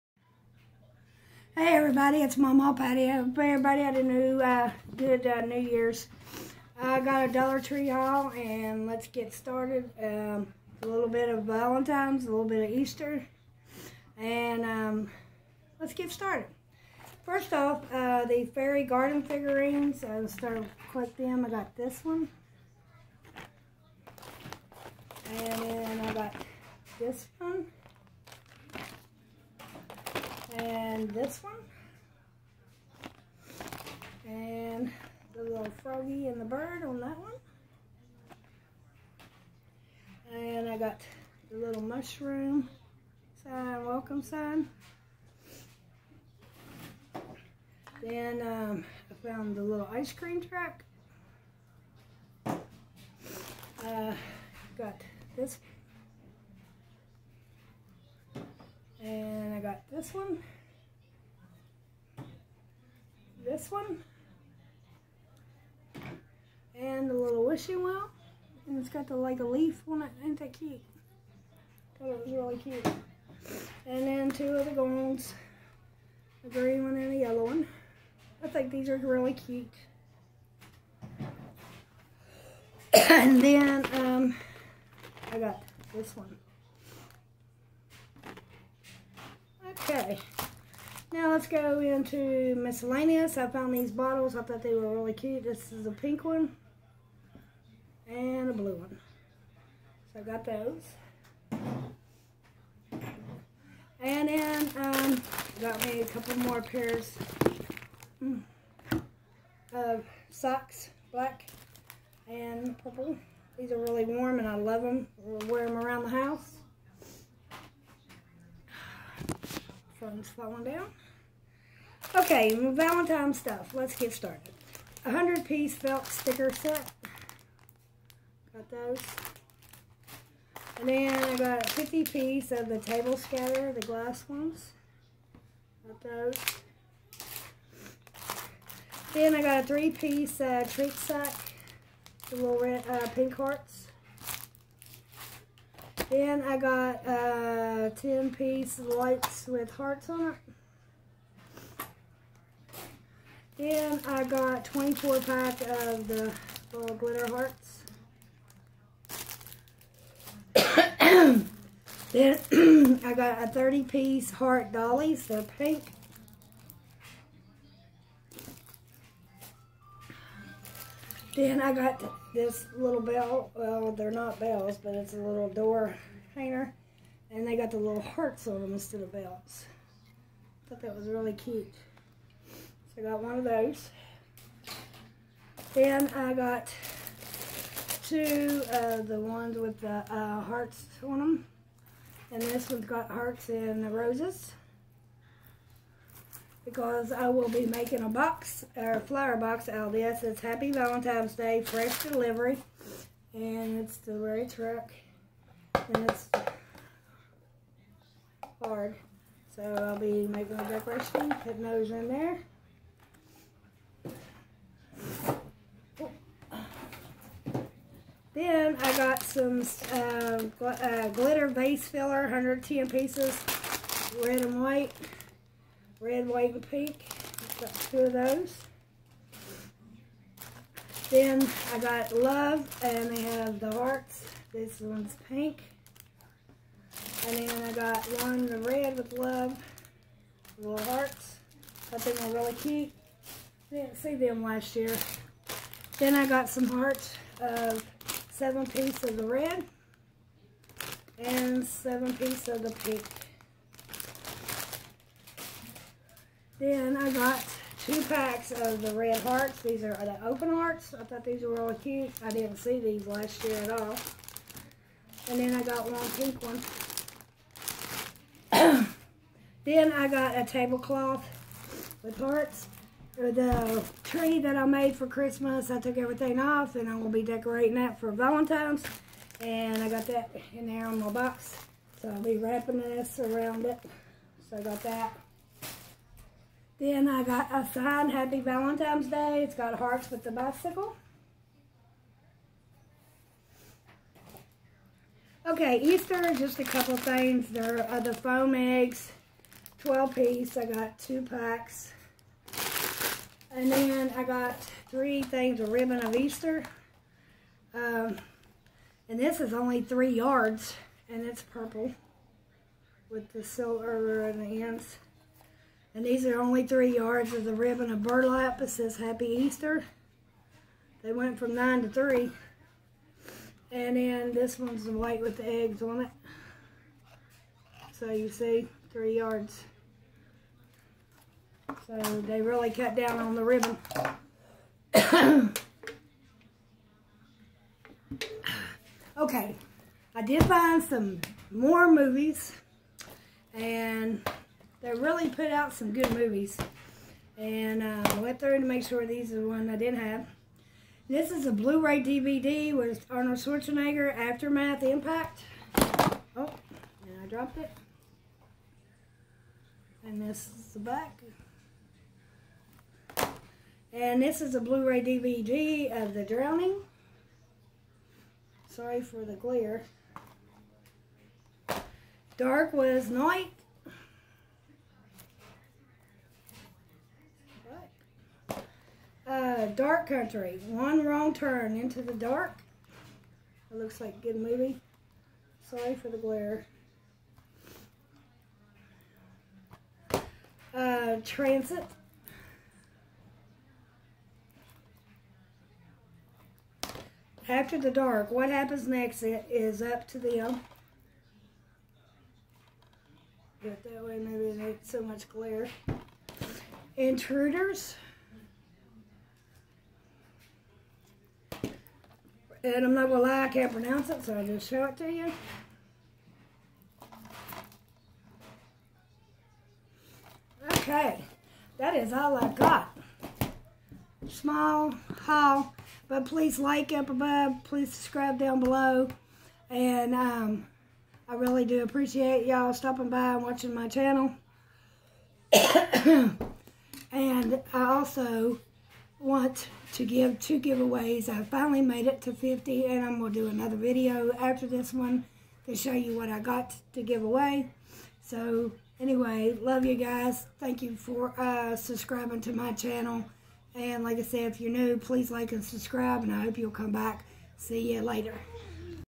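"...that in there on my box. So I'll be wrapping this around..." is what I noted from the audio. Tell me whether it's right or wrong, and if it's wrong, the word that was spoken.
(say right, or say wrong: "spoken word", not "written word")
right.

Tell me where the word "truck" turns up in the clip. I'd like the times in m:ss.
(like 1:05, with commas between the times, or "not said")
0:50, 3:24.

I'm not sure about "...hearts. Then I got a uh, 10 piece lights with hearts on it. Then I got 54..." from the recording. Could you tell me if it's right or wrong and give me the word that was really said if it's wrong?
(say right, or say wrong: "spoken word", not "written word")
wrong: "24", not "54".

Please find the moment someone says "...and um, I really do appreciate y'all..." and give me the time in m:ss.
7:09.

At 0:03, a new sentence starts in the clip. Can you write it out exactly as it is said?
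I hope everybody had a new, uh, good uh, New Year's.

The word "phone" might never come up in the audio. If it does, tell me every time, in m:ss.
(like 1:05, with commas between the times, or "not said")
2:00.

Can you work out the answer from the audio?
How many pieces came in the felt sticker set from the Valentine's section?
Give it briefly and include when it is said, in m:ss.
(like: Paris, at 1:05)
100, at 2:05.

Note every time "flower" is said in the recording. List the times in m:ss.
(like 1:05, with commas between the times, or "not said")
3:18.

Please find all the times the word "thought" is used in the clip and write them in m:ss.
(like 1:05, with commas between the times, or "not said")
1:34, 3:00, 4:21.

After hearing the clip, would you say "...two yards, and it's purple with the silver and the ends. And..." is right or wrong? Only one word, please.
wrong.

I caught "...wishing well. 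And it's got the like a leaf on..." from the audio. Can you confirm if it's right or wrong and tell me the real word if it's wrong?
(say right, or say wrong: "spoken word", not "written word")
right.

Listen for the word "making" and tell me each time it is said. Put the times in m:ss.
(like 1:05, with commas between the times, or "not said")
3:17, 3:30.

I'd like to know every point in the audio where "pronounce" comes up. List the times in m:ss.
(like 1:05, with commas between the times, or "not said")
6:53.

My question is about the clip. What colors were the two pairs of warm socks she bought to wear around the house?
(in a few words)
Black and purple.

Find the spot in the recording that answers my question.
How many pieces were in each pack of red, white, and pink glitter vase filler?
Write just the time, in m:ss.
3:42.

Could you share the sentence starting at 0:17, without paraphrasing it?
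First off, uh, the fairy garden figurines.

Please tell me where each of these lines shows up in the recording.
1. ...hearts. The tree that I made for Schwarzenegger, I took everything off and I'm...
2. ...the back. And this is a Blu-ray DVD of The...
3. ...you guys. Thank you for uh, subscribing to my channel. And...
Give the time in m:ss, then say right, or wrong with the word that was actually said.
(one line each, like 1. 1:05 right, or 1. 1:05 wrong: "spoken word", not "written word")
1. 4:32 wrong: "Christmas", not "Schwarzenegger"
2. 6:00 right
3. 7:29 right.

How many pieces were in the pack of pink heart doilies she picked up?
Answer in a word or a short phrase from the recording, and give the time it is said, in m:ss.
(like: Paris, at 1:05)
30, at 2:43.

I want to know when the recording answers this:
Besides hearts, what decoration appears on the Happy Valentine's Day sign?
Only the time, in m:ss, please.
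4:50.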